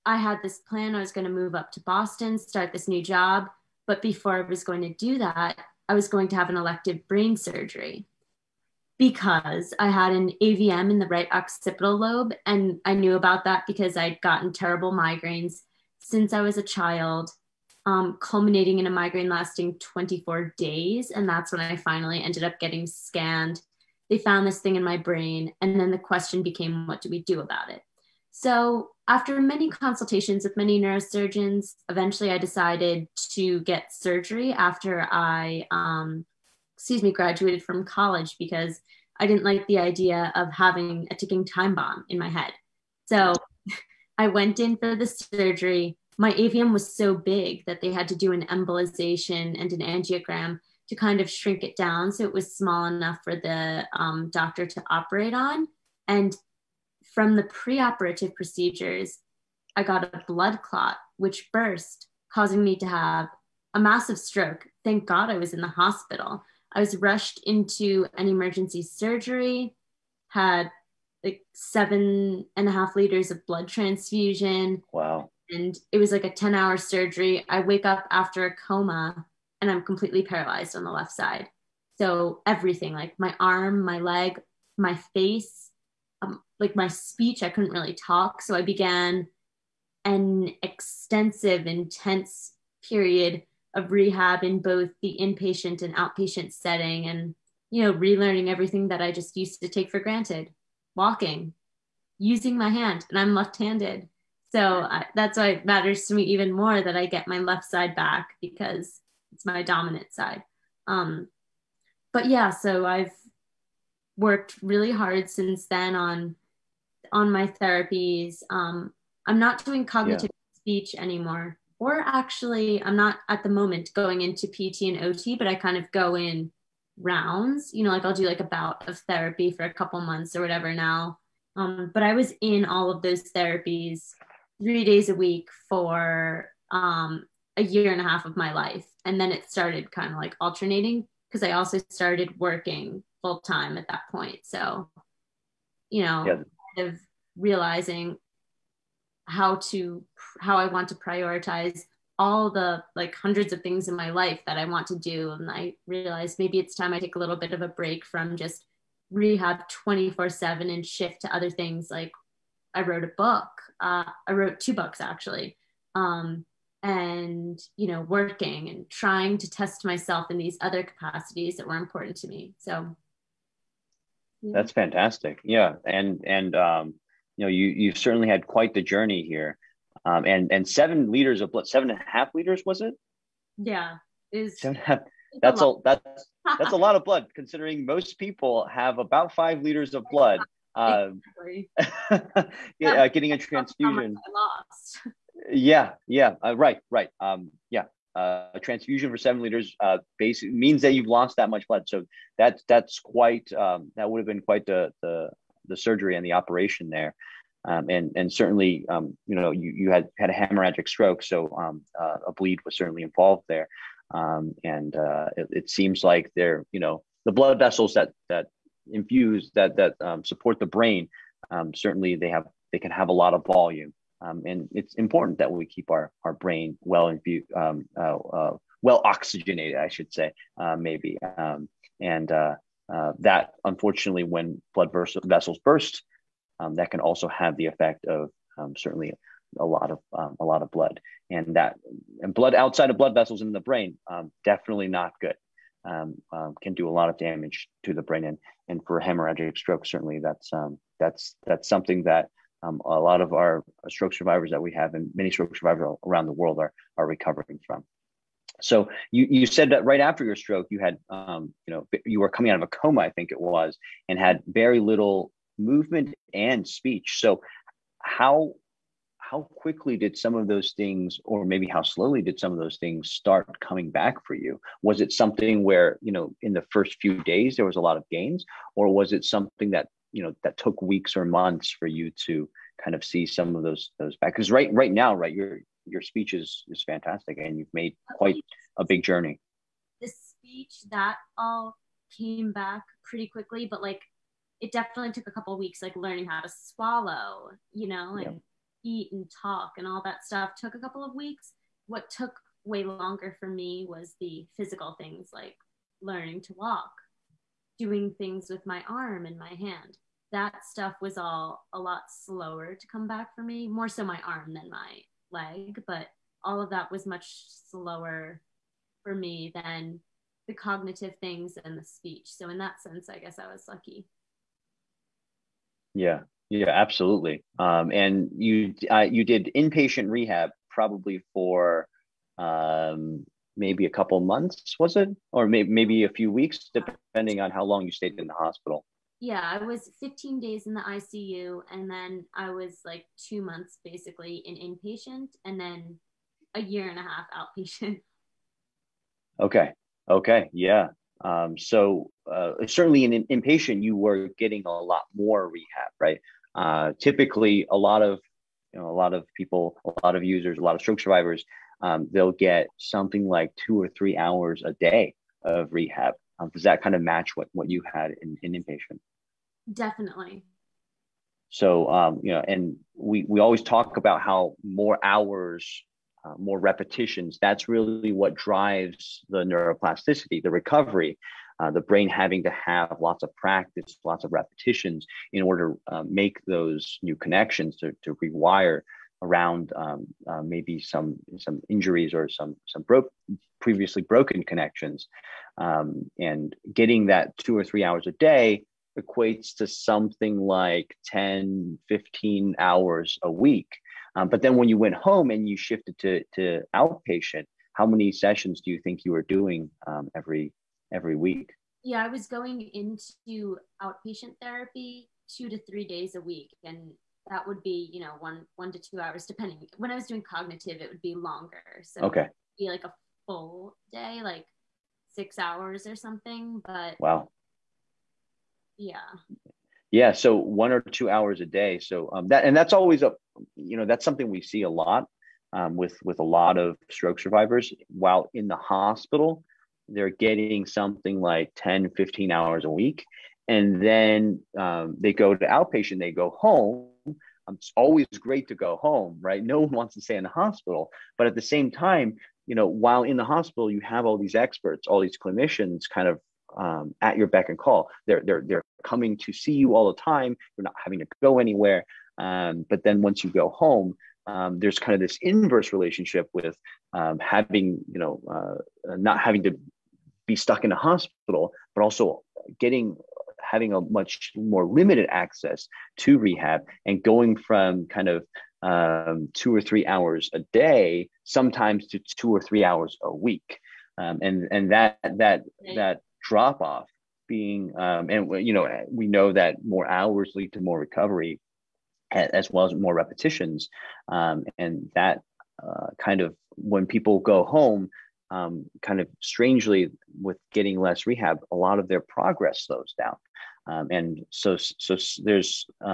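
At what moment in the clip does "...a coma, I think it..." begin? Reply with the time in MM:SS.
04:22.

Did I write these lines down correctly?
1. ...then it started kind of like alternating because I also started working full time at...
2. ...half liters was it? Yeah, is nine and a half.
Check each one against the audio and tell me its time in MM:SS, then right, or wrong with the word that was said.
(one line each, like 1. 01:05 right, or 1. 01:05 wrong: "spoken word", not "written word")
1. 02:19 right
2. 03:02 wrong: "seven", not "nine".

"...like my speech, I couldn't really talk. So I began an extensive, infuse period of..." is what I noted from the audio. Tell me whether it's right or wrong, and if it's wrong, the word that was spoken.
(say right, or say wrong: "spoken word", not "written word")
wrong: "intense", not "infuse".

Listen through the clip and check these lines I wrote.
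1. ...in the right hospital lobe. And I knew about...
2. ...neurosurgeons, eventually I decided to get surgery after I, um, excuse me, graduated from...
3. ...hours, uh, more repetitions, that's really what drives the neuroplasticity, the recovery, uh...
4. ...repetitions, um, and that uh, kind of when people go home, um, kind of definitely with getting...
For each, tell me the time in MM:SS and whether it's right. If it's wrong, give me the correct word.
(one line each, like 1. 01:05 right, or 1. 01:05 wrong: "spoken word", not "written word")
1. 00:10 wrong: "occipital", not "hospital"
2. 00:30 right
3. 06:15 right
4. 08:12 wrong: "strangely", not "definitely".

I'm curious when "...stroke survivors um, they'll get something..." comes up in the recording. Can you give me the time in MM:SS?
06:00.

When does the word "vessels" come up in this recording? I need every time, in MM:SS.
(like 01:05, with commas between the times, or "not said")
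03:37, 03:55, 04:03.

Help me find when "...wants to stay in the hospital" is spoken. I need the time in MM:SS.
07:29.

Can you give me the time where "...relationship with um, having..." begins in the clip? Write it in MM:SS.
07:45.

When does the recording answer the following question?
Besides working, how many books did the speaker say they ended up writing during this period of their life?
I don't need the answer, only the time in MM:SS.
02:44.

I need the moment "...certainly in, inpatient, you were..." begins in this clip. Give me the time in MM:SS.
05:52.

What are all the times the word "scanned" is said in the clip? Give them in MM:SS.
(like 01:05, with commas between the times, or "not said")
00:22.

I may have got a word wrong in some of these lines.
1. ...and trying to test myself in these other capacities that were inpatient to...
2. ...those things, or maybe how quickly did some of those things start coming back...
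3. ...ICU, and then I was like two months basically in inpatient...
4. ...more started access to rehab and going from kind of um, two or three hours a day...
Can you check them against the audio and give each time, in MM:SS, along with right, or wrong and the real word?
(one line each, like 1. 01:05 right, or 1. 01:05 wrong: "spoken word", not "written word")
1. 02:48 wrong: "important", not "inpatient"
2. 04:30 wrong: "slowly", not "quickly"
3. 05:40 right
4. 07:54 wrong: "limited", not "started".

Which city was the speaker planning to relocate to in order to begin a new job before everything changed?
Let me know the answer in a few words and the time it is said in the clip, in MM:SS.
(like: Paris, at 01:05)
Boston, at 00:01.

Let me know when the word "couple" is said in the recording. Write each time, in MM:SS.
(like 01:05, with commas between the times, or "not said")
02:09, 04:55, 05:00, 05:33.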